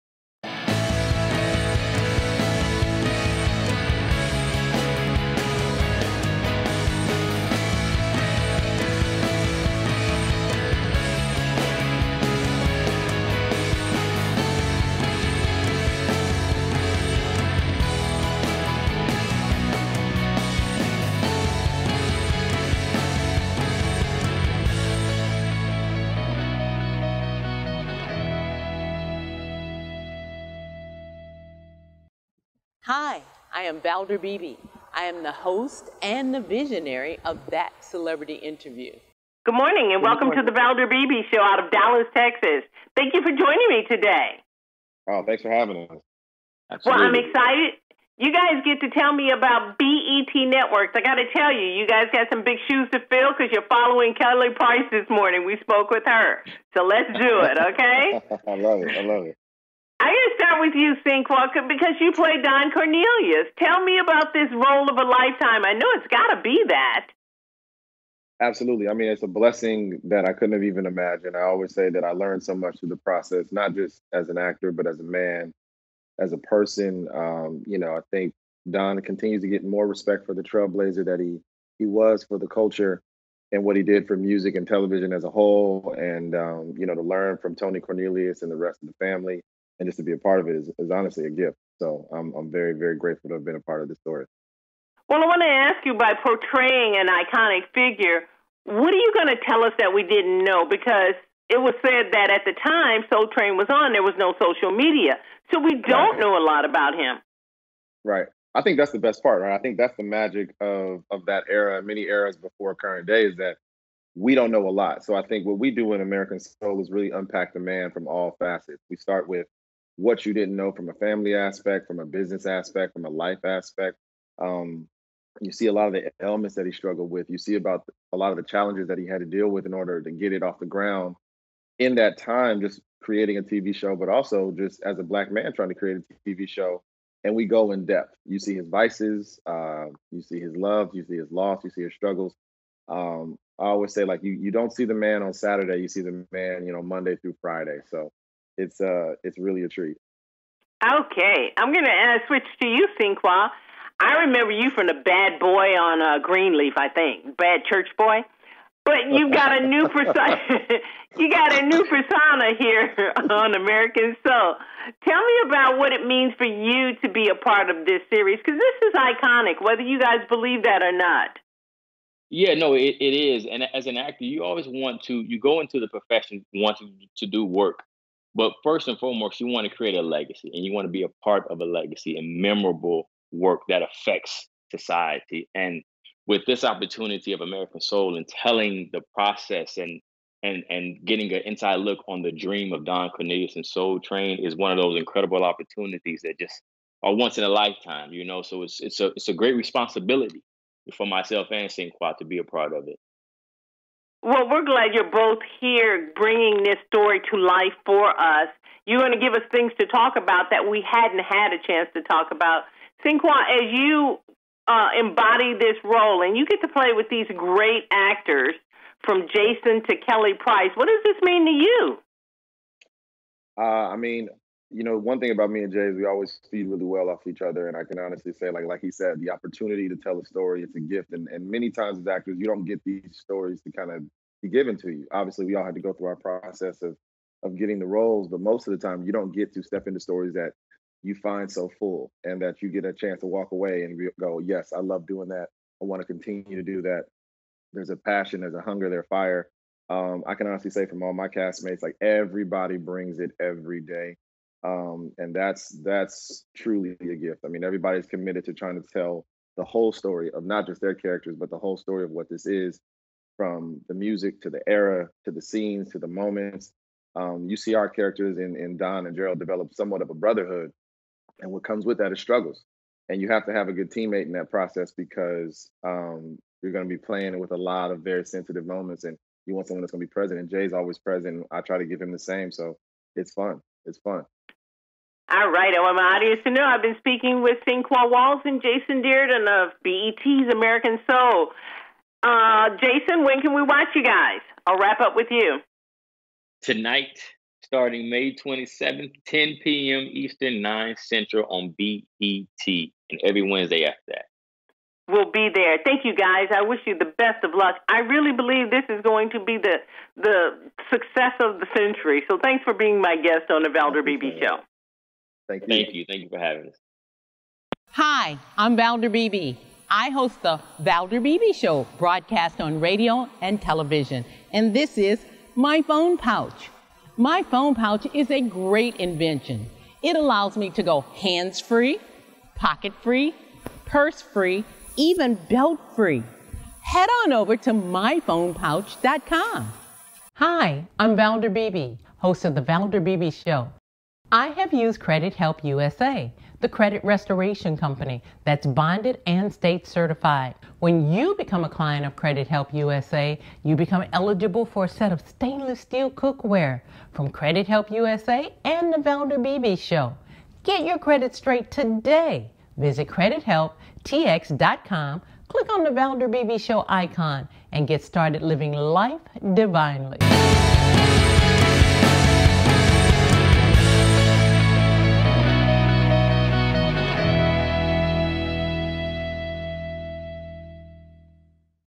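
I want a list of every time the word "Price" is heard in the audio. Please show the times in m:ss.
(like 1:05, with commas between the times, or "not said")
0:54, 3:40.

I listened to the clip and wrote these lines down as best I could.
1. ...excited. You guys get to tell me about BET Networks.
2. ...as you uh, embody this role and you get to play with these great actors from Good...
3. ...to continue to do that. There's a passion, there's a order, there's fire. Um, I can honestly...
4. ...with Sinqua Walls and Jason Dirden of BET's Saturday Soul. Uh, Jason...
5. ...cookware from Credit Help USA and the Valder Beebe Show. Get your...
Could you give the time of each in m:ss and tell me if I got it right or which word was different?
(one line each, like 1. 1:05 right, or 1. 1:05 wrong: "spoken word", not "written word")
1. 0:47 right
2. 3:33 wrong: "Jason", not "Good"
3. 4:06 wrong: "hunger", not "order"
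4. 4:47 wrong: "American", not "Saturday"
5. 5:56 right.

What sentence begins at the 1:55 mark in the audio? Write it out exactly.
So I think what we do in American Soul is really unpack the man from all facets.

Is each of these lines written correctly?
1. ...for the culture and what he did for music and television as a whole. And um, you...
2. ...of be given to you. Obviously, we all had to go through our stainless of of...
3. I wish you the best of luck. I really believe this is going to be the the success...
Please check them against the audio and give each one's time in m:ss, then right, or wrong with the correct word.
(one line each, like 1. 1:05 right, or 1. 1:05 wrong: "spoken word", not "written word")
1. 1:22 right
2. 3:53 wrong: "process", not "stainless"
3. 5:06 right.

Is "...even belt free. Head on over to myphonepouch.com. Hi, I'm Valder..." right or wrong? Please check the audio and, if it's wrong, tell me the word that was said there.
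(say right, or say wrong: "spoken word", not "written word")
right.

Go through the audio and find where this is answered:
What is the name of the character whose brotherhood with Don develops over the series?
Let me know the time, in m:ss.
4:29.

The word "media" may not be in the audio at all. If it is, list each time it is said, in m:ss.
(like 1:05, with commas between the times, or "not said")
1:44.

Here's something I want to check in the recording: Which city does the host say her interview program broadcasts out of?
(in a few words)
Dallas, Texas.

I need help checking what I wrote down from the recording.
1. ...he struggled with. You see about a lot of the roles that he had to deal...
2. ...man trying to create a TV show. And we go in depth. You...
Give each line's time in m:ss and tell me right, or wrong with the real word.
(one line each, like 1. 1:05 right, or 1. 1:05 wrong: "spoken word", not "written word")
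1. 2:06 wrong: "challenges", not "roles"
2. 2:15 right.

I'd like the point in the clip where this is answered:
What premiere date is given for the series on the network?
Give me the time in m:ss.
4:58.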